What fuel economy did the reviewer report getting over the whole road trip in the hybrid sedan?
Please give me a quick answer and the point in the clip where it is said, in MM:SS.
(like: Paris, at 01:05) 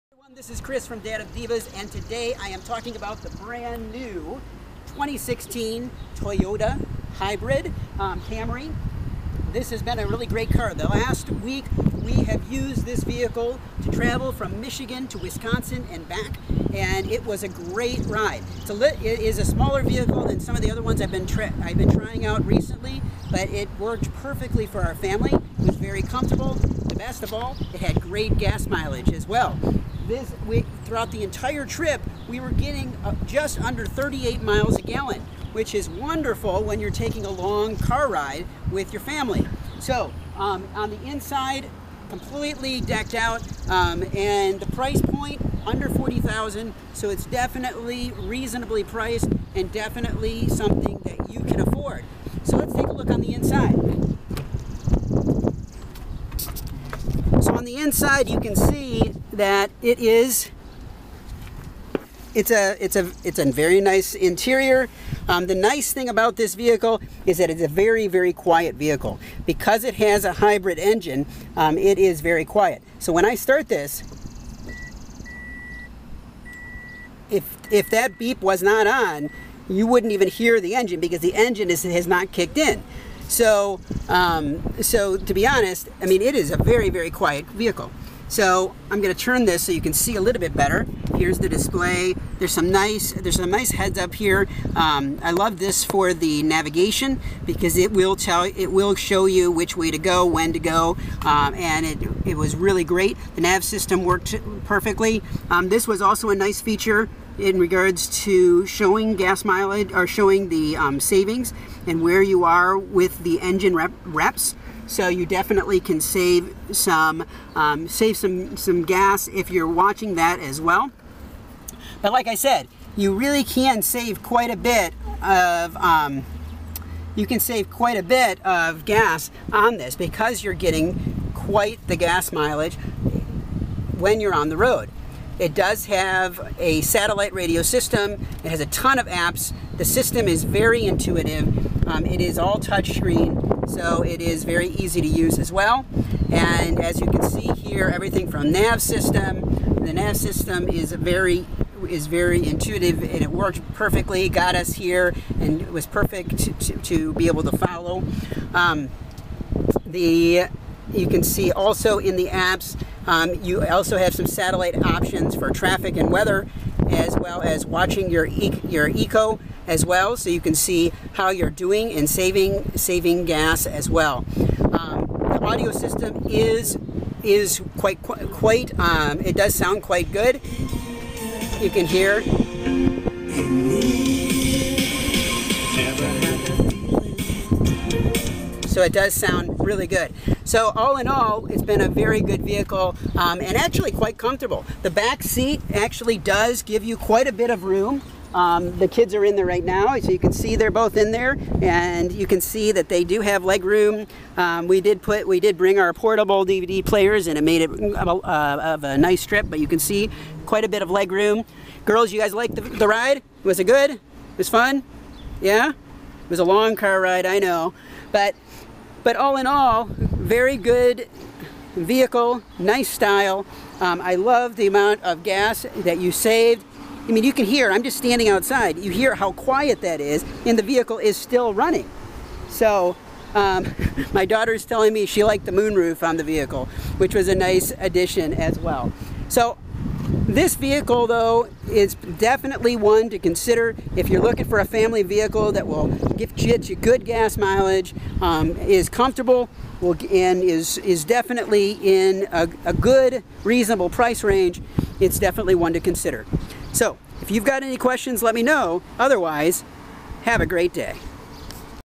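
just under 38 miles a gallon, at 00:33.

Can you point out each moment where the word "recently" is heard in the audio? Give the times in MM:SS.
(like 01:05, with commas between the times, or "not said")
00:22.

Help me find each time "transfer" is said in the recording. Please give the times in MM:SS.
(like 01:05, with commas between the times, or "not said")
not said.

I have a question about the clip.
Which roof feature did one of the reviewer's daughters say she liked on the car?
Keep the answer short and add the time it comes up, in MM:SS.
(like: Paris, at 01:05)
moonroof, at 03:55.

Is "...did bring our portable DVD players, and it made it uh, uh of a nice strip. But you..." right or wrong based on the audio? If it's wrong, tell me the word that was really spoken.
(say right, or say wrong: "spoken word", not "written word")
right.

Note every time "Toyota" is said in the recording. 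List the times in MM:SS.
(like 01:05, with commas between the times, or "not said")
00:06.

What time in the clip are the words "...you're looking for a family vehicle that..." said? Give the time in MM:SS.
04:04.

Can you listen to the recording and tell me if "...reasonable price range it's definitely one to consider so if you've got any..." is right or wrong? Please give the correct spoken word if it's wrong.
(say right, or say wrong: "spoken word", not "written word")
right.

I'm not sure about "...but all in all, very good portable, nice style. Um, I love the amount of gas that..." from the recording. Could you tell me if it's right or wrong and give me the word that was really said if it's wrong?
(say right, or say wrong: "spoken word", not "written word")
wrong: "vehicle", not "portable".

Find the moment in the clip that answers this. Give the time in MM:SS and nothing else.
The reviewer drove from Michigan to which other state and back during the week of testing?
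00:15.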